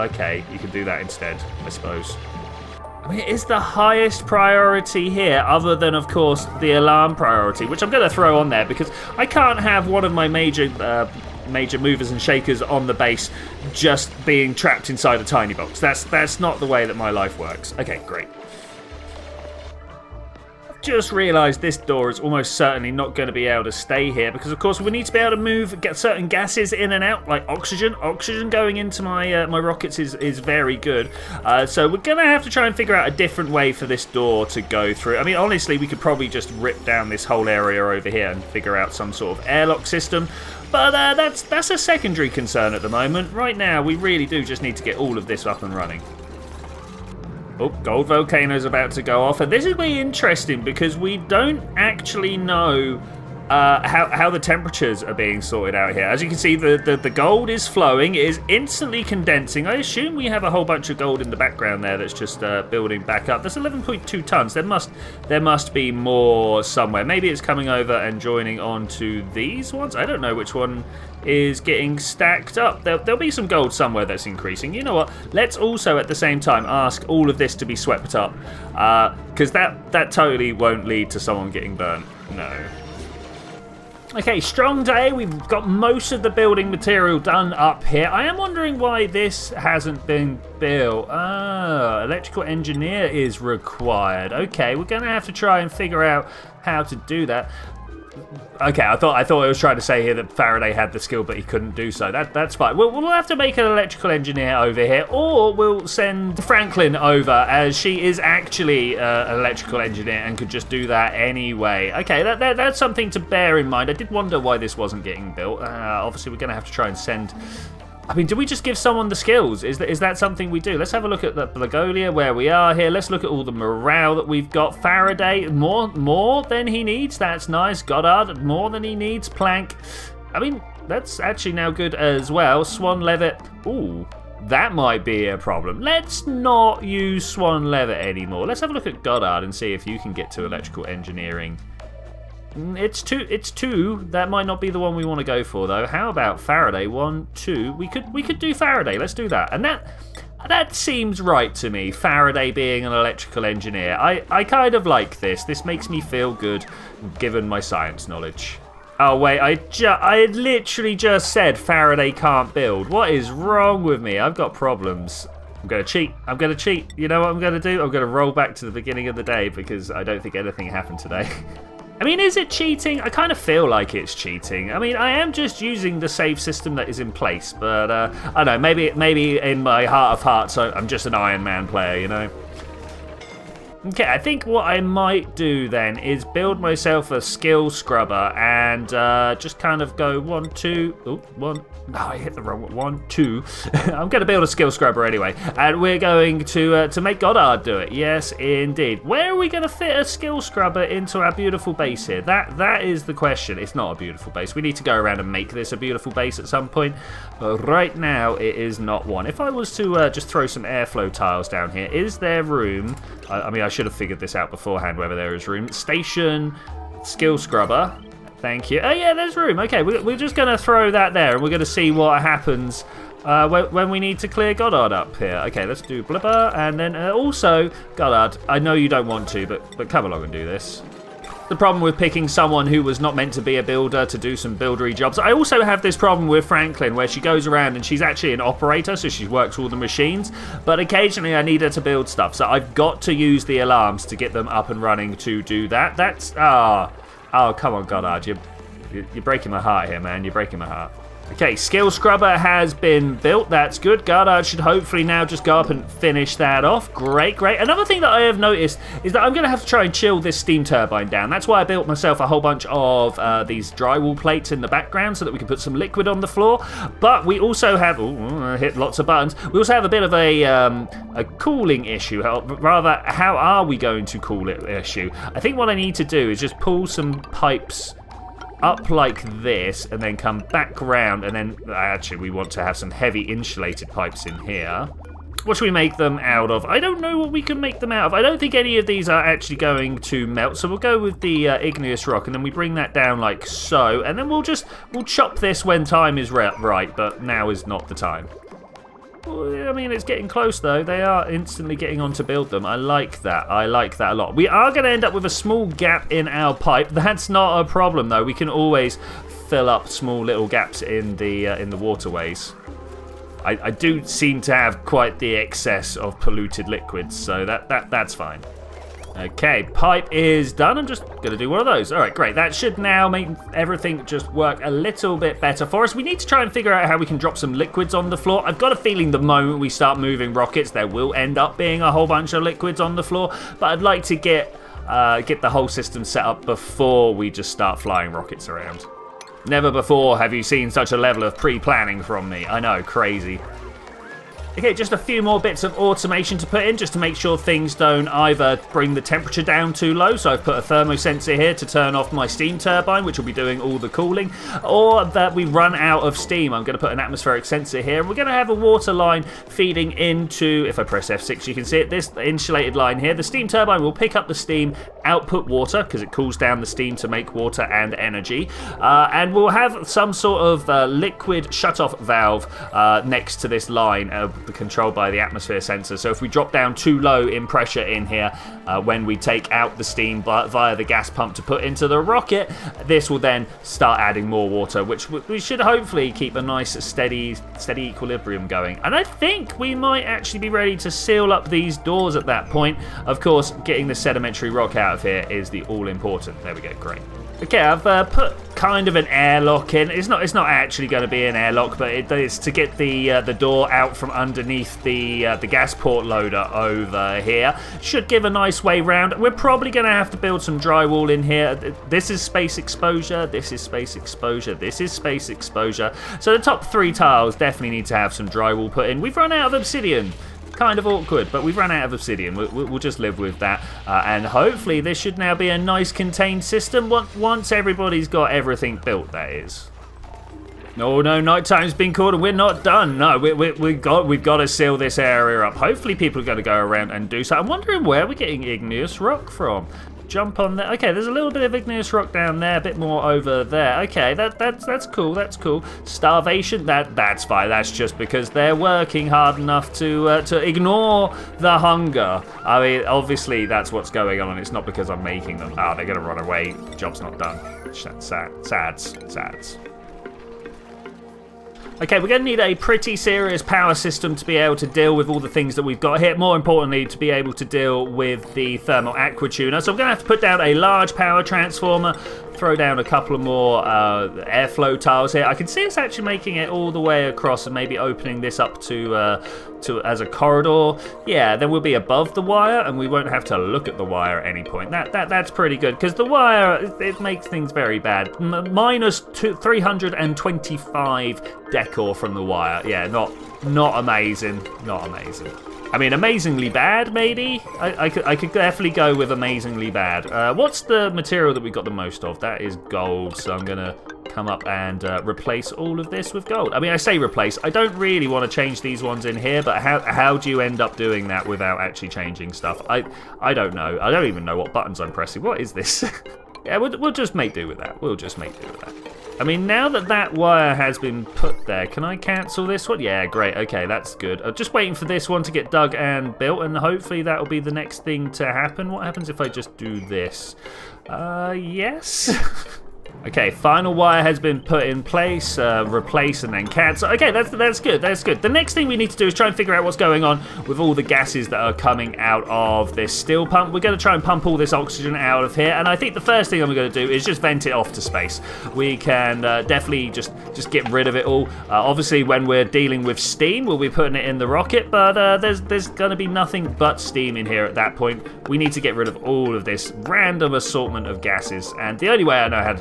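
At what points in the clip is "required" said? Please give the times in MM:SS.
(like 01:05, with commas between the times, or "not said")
01:33.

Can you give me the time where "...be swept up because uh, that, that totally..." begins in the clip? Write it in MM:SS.
01:17.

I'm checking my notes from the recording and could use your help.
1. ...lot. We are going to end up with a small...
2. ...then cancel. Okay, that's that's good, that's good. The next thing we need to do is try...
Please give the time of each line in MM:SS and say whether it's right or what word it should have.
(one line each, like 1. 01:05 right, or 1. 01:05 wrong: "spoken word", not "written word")
1. 05:04 right
2. 08:56 right.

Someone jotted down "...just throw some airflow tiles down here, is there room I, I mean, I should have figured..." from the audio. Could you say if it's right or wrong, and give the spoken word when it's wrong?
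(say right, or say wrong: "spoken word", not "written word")
right.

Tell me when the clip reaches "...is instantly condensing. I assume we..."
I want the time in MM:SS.
00:58.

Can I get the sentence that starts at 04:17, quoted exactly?
Another thing that I have noticed is that I'm going to have to try and chill this steam turbine down.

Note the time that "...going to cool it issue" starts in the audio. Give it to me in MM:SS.
04:33.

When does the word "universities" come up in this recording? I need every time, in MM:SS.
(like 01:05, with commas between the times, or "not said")
not said.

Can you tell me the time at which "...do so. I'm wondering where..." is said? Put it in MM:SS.
07:17.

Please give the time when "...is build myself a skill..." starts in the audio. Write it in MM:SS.
03:05.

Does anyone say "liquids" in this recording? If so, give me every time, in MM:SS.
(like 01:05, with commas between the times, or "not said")
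04:25, 05:16, 05:27, 05:32, 06:10.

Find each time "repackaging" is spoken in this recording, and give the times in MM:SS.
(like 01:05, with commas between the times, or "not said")
not said.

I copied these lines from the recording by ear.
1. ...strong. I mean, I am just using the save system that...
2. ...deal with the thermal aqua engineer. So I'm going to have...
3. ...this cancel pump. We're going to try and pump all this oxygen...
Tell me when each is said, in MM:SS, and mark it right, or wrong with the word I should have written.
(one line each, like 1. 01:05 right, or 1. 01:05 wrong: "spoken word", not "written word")
1. 02:54 wrong: "cheating", not "strong"
2. 07:47 wrong: "tuner", not "engineer"
3. 09:02 wrong: "steel", not "cancel".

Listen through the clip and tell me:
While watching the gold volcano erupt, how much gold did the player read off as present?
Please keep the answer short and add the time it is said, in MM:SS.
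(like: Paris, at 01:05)
11.2 tons, at 01:03.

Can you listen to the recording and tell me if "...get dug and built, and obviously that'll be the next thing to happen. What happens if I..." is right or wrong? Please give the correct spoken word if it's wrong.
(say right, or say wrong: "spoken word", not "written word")
wrong: "hopefully", not "obviously".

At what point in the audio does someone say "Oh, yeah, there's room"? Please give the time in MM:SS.
03:38.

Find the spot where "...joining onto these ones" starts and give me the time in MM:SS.
01:08.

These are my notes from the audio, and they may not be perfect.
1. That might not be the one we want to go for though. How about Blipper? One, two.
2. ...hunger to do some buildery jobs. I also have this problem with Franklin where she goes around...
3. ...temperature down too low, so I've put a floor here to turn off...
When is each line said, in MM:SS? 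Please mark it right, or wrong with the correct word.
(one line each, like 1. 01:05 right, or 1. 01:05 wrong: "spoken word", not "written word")
1. 02:24 wrong: "Faraday", not "Blipper"
2. 03:53 wrong: "builder", not "hunger"
3. 05:49 wrong: "thermosensor", not "floor".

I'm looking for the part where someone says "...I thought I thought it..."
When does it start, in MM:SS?
01:38.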